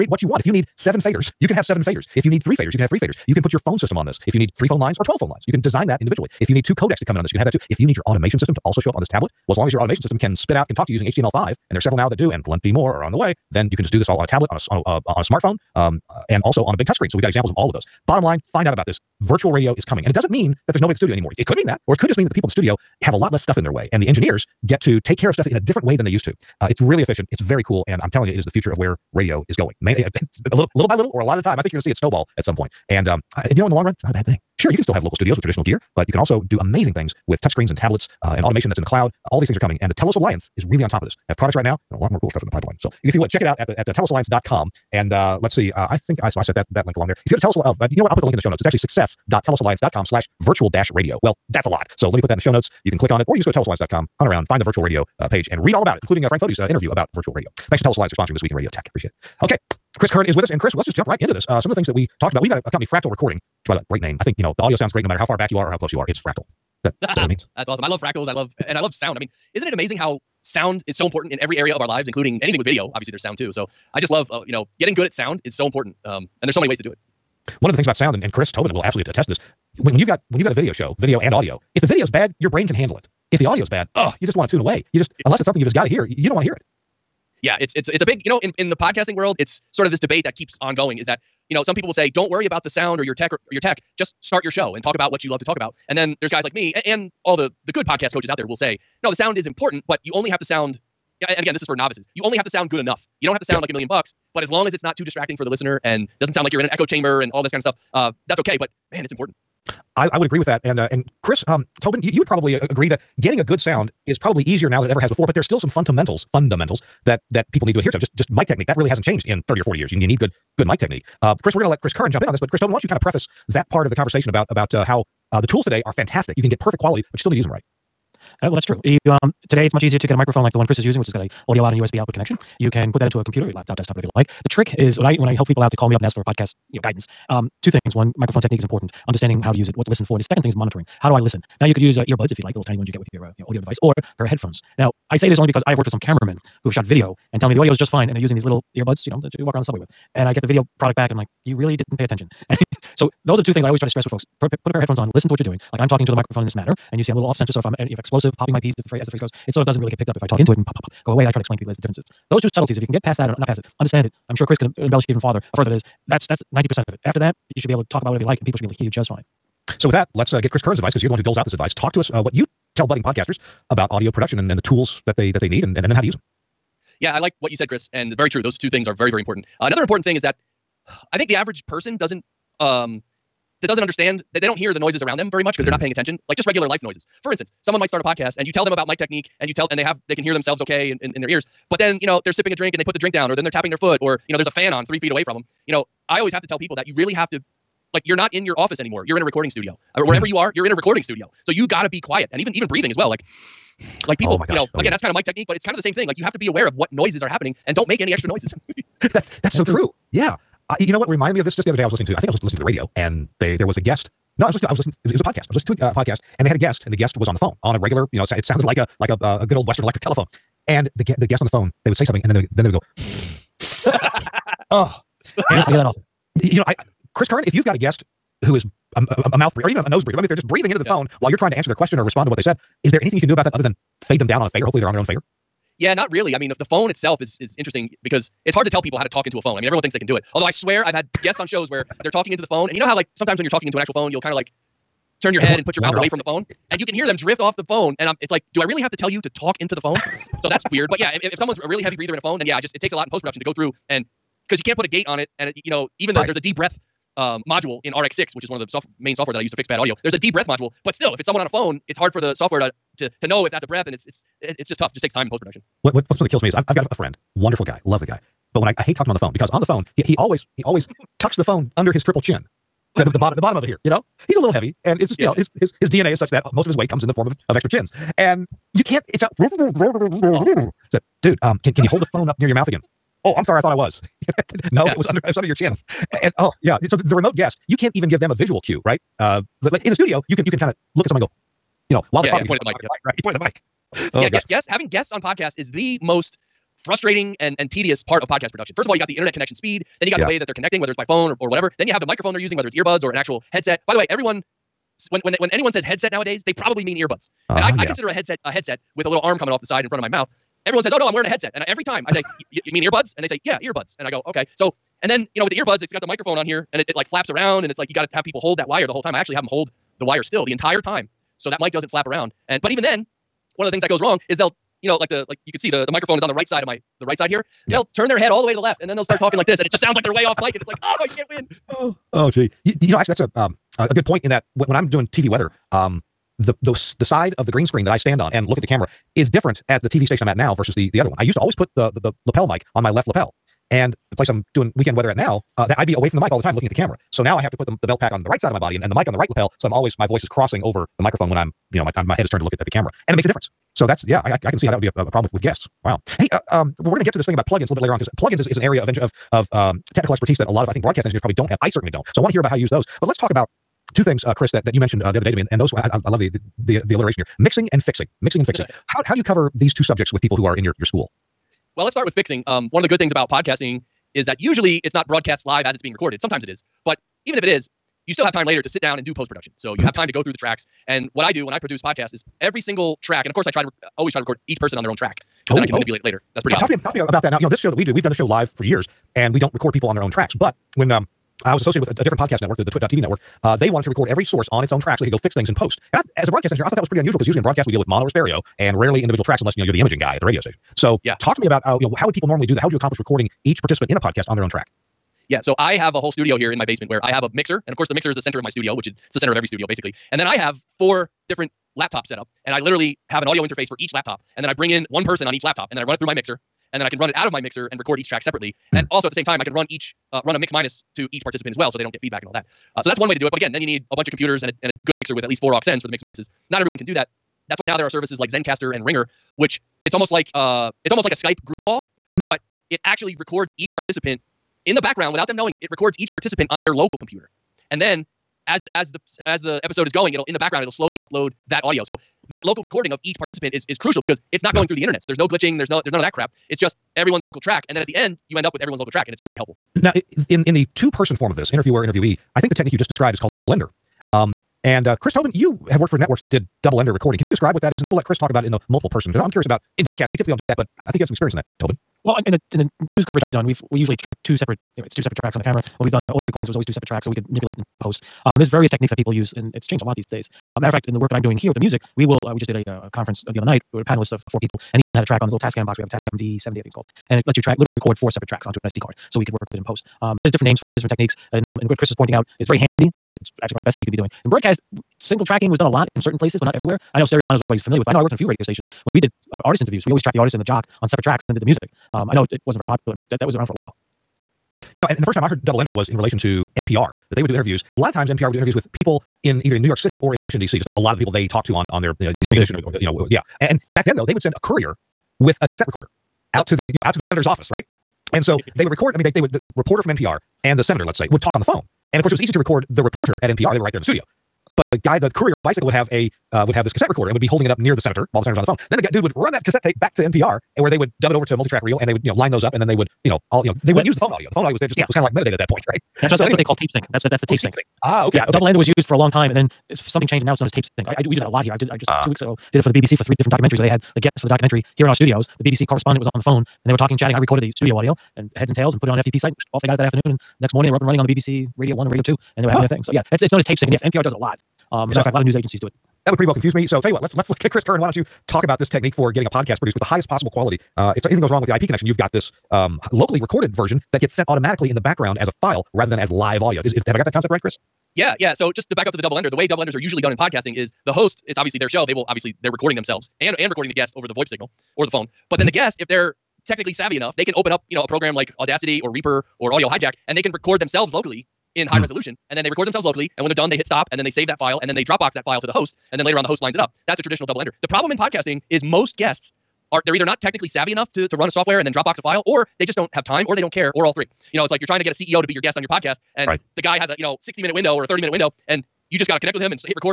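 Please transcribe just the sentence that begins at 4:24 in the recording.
It just takes time in post production.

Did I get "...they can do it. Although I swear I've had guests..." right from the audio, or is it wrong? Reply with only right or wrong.
right.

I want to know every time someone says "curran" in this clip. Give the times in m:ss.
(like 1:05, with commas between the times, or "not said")
1:00, 2:01, 2:50, 3:47, 9:07.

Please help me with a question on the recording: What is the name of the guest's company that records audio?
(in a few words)
Fractal Recording.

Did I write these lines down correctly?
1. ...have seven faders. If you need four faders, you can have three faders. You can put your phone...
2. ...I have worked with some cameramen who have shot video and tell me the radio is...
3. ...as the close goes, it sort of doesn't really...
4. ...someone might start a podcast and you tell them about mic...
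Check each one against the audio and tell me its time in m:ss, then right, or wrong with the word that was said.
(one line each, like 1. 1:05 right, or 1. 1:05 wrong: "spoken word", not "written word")
1. 0:01 wrong: "three", not "four"
2. 2:25 wrong: "audio", not "radio"
3. 2:39 wrong: "phrase", not "close"
4. 3:07 right.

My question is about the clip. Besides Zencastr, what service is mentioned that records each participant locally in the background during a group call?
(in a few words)
Ringr.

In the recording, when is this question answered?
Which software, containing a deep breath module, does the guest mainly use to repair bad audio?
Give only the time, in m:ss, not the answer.
4:17.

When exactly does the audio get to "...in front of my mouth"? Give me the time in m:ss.
5:09.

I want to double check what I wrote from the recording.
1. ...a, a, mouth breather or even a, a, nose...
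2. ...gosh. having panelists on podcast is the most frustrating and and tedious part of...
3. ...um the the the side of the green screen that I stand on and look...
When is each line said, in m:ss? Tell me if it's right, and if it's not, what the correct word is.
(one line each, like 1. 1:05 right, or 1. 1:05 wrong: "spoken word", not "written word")
1. 3:49 right
2. 4:54 wrong: "guests", not "panelists"
3. 5:35 right.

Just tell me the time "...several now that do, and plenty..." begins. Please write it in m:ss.
0:11.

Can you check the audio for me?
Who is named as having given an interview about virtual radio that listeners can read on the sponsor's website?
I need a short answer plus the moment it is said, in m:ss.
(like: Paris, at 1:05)
Frank Foti, at 0:56.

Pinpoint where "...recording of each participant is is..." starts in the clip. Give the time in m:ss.
7:22.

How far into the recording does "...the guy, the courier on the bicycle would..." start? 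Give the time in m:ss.
8:34.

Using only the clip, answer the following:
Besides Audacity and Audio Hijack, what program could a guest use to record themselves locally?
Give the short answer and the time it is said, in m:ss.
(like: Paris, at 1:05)
Reaper, at 9:28.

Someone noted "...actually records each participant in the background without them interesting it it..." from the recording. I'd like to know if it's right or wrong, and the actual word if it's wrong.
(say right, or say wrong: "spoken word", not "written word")
wrong: "knowing", not "interesting".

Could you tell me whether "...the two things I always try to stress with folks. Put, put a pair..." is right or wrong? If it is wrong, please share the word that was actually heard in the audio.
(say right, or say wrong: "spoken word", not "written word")
right.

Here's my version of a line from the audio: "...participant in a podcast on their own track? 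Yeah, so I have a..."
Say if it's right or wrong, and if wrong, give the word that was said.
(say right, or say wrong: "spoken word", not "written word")
right.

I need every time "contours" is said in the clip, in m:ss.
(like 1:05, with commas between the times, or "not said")
not said.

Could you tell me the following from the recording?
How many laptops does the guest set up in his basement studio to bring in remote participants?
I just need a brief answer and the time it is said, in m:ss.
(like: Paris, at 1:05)
4, at 6:50.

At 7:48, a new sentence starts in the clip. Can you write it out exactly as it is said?
Um, there's various techniques that people use, and it's changed a lot these days.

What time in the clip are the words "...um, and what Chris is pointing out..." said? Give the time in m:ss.
8:01.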